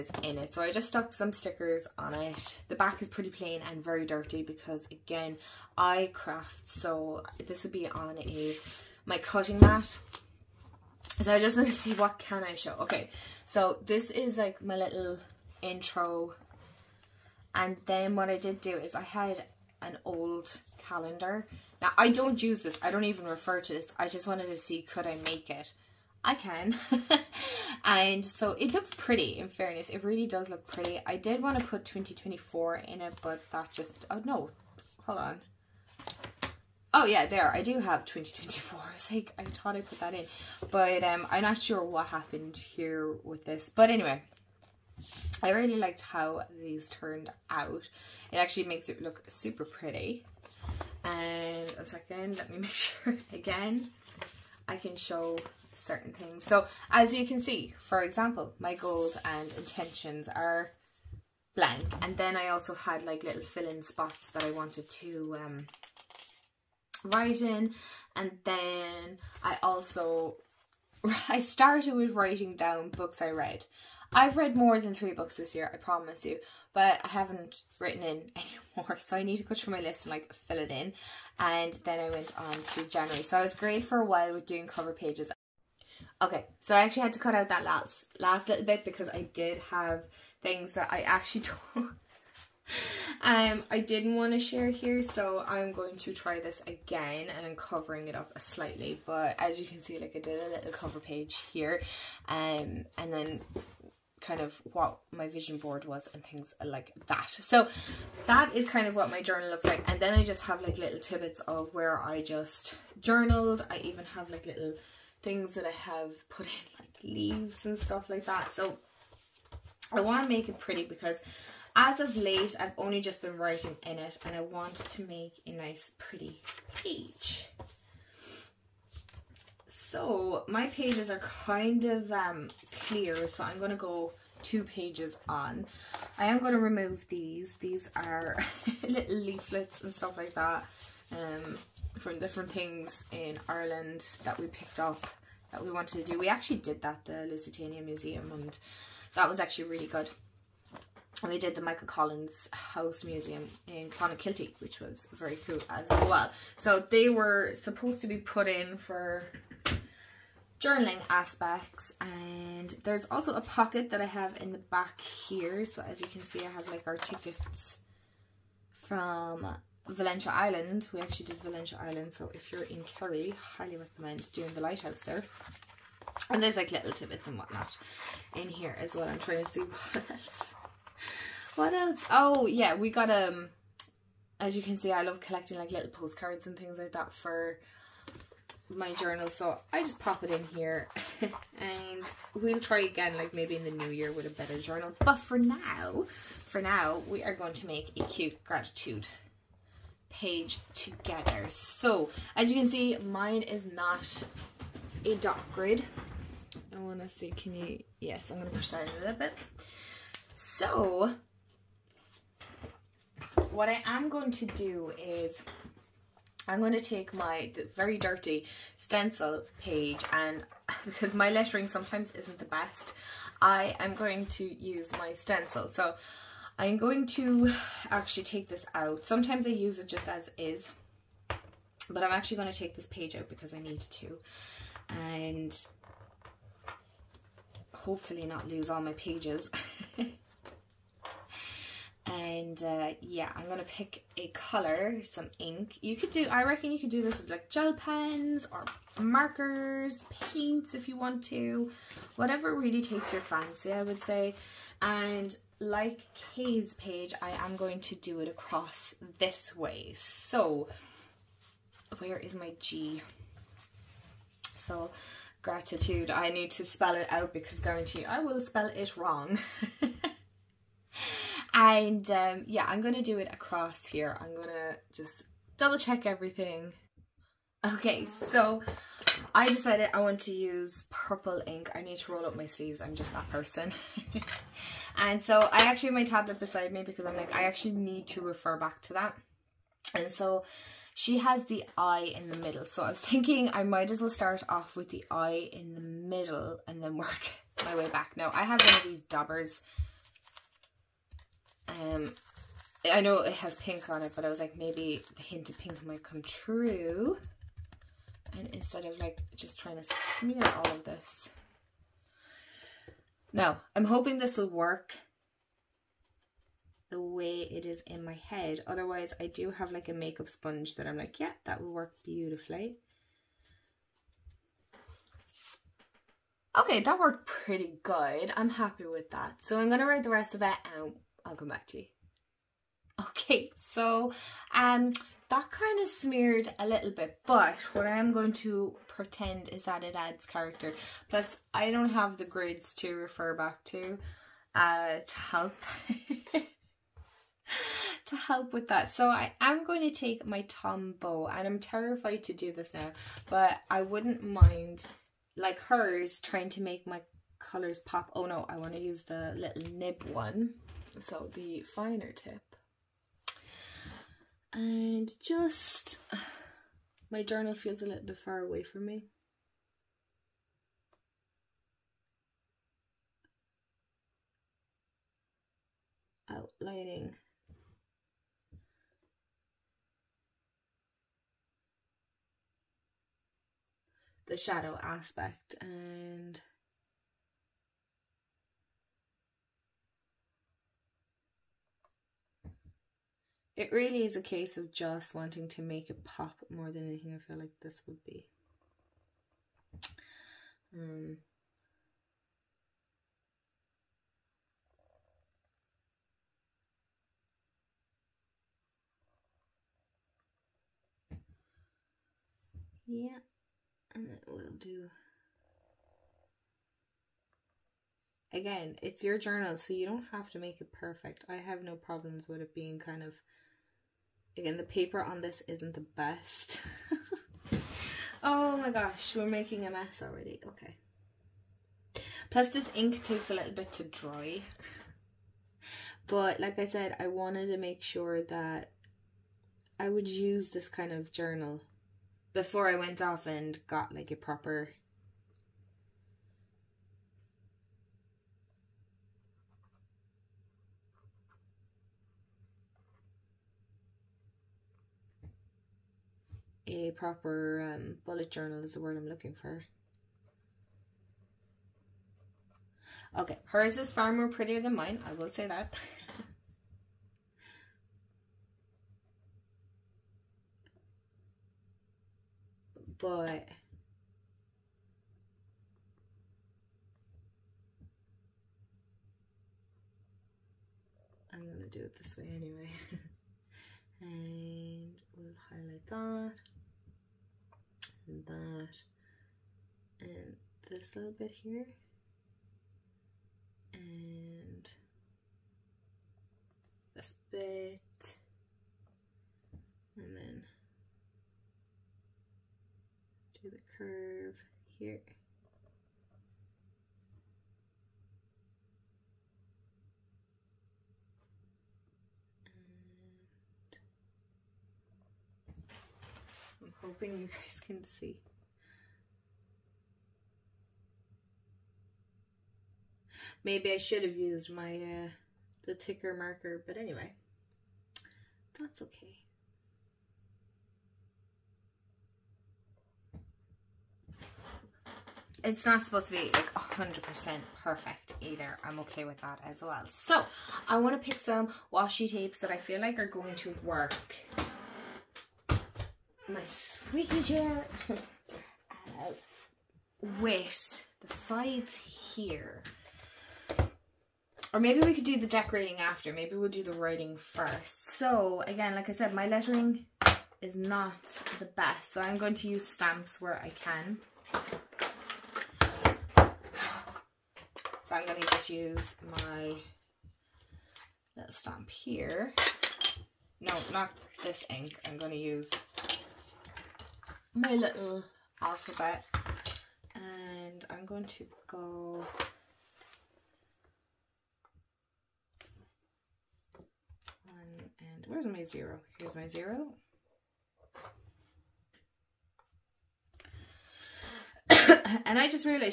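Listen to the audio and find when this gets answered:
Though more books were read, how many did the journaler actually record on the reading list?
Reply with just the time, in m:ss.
1:14.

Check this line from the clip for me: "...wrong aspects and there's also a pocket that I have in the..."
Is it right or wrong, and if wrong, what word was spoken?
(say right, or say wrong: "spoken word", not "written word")
wrong: "journaling", not "wrong".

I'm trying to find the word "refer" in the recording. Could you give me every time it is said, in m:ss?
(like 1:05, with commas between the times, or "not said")
0:23, 4:48, 5:42.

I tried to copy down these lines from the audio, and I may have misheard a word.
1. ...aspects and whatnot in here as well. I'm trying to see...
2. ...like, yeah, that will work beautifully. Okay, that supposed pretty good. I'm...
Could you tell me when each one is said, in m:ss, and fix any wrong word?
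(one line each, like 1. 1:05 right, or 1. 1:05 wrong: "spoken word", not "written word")
1. 2:56 wrong: "tidbits", not "aspects"
2. 5:20 wrong: "worked", not "supposed".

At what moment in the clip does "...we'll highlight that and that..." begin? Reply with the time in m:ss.
8:05.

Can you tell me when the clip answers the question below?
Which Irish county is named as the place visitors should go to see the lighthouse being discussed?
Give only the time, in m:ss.
2:52.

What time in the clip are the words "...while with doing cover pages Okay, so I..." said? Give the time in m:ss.
1:24.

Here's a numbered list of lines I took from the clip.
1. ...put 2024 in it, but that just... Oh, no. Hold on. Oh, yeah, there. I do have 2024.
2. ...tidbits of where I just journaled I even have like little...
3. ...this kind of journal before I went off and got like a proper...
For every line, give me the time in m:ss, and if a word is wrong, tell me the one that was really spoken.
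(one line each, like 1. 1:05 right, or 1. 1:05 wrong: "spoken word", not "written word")
1. 0:31 right
2. 1:50 right
3. 7:20 right.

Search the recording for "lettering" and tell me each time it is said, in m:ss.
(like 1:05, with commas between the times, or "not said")
3:41, 9:19.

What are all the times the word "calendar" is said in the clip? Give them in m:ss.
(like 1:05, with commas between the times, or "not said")
0:20.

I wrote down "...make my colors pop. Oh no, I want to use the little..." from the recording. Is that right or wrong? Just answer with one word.
right.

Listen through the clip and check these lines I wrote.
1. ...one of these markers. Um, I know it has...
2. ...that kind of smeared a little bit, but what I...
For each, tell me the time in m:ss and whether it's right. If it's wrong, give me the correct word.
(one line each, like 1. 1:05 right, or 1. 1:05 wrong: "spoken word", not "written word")
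1. 4:58 wrong: "dabbers", not "markers"
2. 5:35 right.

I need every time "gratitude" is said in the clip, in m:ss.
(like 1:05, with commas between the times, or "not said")
3:18, 4:25.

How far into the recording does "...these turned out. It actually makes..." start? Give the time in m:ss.
0:46.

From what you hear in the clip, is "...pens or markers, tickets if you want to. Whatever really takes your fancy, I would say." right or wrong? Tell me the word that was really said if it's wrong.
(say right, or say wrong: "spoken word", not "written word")
wrong: "paints", not "tickets".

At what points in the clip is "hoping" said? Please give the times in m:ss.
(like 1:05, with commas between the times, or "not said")
5:13, 8:36.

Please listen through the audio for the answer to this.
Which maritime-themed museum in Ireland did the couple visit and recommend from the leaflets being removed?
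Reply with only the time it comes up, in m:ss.
2:27.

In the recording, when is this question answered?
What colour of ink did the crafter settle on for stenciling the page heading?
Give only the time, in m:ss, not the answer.
4:40.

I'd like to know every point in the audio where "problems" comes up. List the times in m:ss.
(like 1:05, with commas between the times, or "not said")
7:01.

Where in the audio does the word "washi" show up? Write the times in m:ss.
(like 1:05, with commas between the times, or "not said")
9:01.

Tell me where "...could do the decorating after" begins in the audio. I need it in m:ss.
9:14.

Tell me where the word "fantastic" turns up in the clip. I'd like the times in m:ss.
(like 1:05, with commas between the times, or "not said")
not said.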